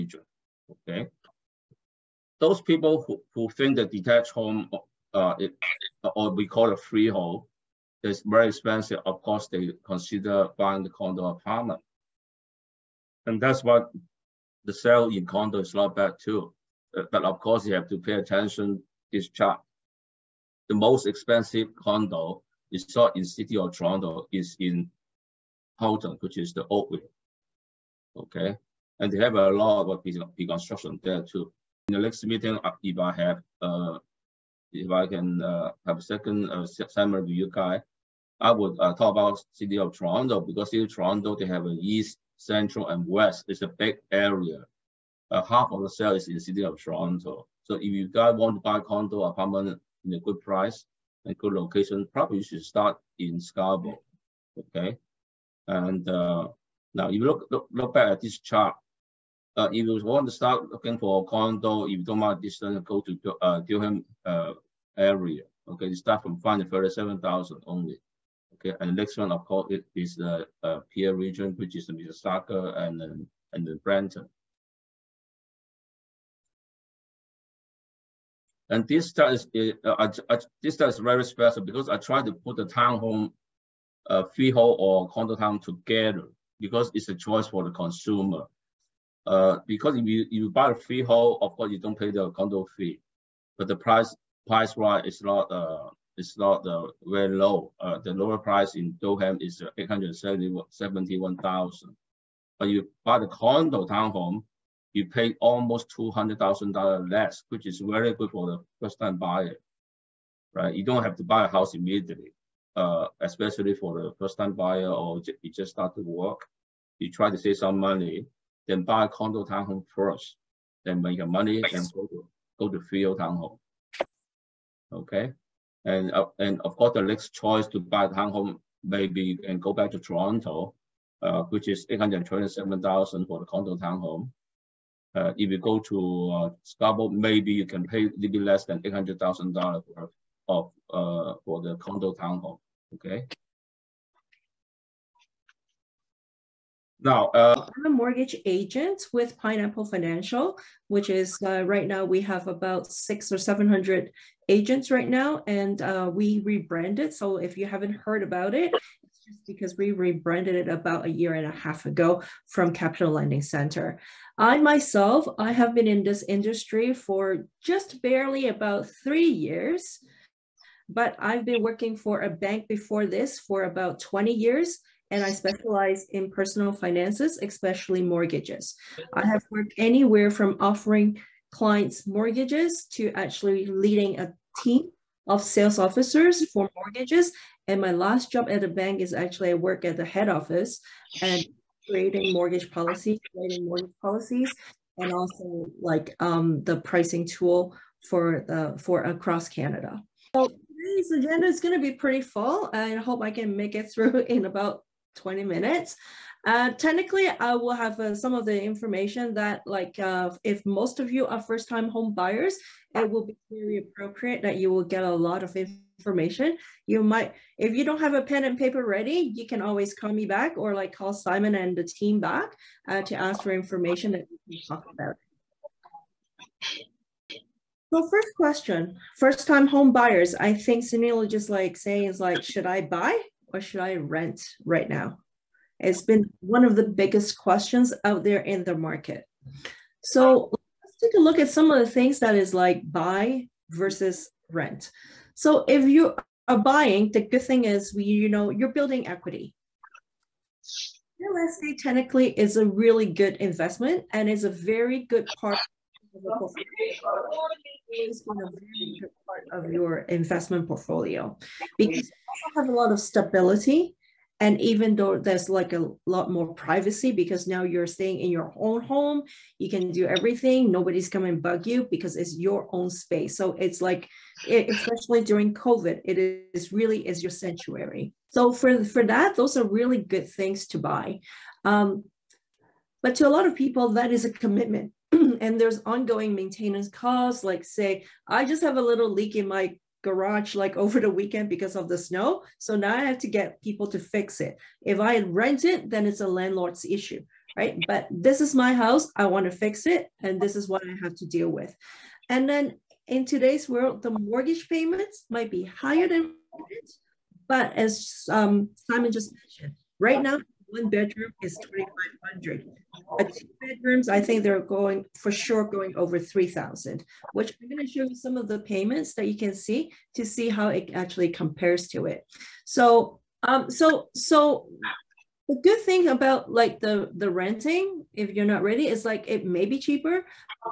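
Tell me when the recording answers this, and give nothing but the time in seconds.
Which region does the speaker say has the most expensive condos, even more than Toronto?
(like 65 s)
25 s.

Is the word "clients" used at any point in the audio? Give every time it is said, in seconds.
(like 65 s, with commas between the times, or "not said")
181 s.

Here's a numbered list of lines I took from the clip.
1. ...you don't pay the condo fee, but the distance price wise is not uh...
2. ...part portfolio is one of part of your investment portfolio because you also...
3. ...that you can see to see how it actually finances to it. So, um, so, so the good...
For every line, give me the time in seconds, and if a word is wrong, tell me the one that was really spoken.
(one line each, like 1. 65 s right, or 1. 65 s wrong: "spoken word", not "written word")
1. 91 s wrong: "price", not "distance"
2. 255 s right
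3. 319 s wrong: "compares", not "finances".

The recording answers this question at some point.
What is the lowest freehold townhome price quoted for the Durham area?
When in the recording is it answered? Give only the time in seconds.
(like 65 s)
99 s.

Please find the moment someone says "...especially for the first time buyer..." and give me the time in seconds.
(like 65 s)
113 s.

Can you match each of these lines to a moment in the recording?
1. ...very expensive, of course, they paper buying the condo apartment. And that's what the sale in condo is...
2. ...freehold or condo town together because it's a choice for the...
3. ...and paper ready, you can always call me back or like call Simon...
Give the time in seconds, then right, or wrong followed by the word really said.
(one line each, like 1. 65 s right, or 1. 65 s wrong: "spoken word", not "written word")
1. 8 s wrong: "consider", not "paper"
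2. 84 s right
3. 218 s right.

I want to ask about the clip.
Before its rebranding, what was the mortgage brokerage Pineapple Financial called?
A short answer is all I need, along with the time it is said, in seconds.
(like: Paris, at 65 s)
Capital Lending Center, at 162 s.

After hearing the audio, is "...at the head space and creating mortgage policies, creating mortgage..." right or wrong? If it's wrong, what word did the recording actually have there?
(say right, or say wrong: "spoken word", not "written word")
wrong: "office", not "space".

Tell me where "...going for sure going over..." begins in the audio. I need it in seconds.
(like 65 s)
314 s.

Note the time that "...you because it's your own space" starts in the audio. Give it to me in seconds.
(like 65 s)
271 s.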